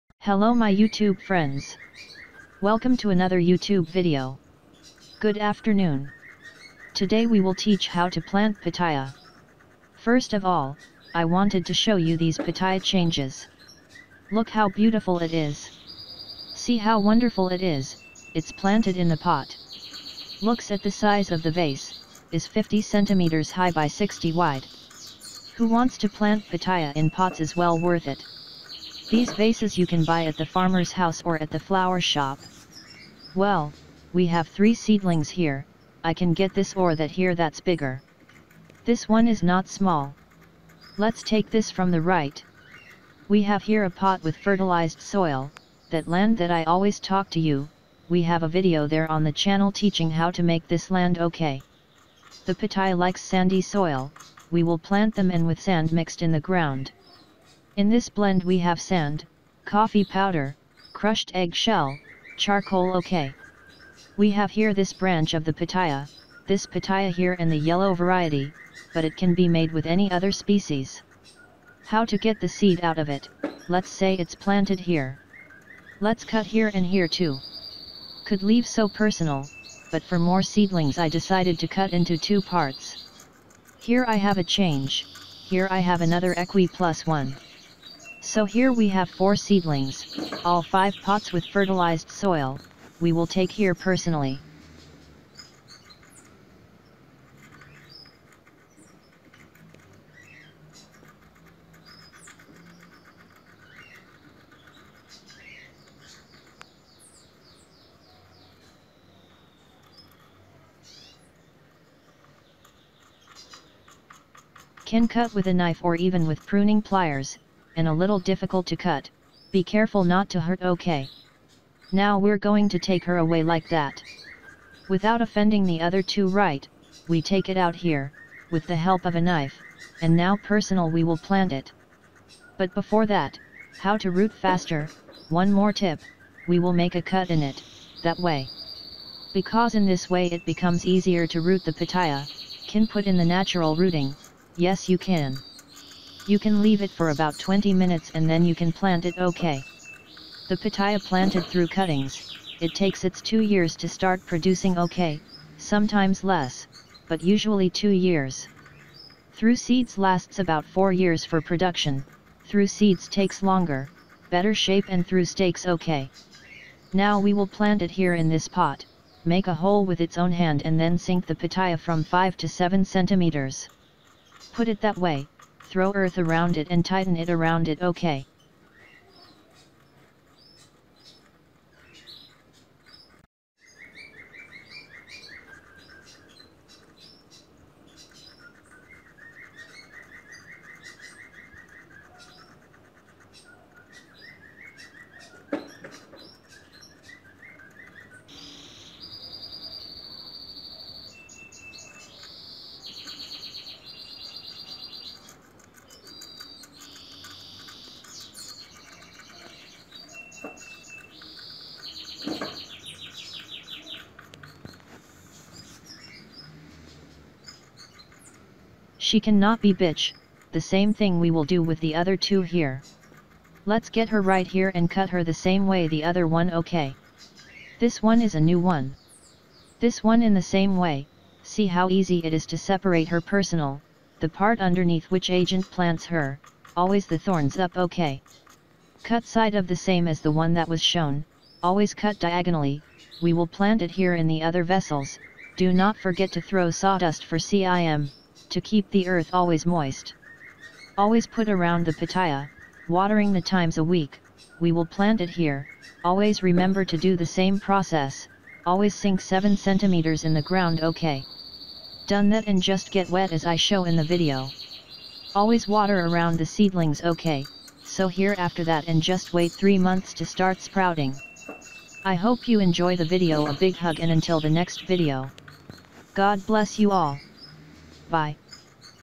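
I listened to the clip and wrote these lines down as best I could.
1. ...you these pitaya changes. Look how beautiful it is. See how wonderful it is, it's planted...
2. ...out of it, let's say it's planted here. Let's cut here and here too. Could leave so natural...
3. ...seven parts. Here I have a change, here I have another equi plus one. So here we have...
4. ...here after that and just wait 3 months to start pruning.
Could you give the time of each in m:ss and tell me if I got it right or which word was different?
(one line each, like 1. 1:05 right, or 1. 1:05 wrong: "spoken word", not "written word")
1. 0:11 right
2. 1:12 wrong: "personal", not "natural"
3. 1:22 wrong: "two", not "seven"
4. 4:28 wrong: "sprouting", not "pruning".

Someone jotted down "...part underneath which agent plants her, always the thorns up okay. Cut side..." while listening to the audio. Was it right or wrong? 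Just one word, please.
right.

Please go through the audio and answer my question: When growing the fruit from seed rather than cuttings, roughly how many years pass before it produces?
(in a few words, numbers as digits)
4 years.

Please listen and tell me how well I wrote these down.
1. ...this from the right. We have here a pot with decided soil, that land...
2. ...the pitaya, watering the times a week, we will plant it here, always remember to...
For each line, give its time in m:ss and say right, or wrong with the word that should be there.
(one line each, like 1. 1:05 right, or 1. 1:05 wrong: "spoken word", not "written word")
1. 0:41 wrong: "fertilized", not "decided"
2. 4:11 right.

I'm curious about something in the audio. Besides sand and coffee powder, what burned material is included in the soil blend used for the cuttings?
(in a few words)
charcoal.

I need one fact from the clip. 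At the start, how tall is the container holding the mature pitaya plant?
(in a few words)
50 centimeters.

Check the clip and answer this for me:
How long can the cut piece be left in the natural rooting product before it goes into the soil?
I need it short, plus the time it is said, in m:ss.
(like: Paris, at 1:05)
20 minutes, at 2:27.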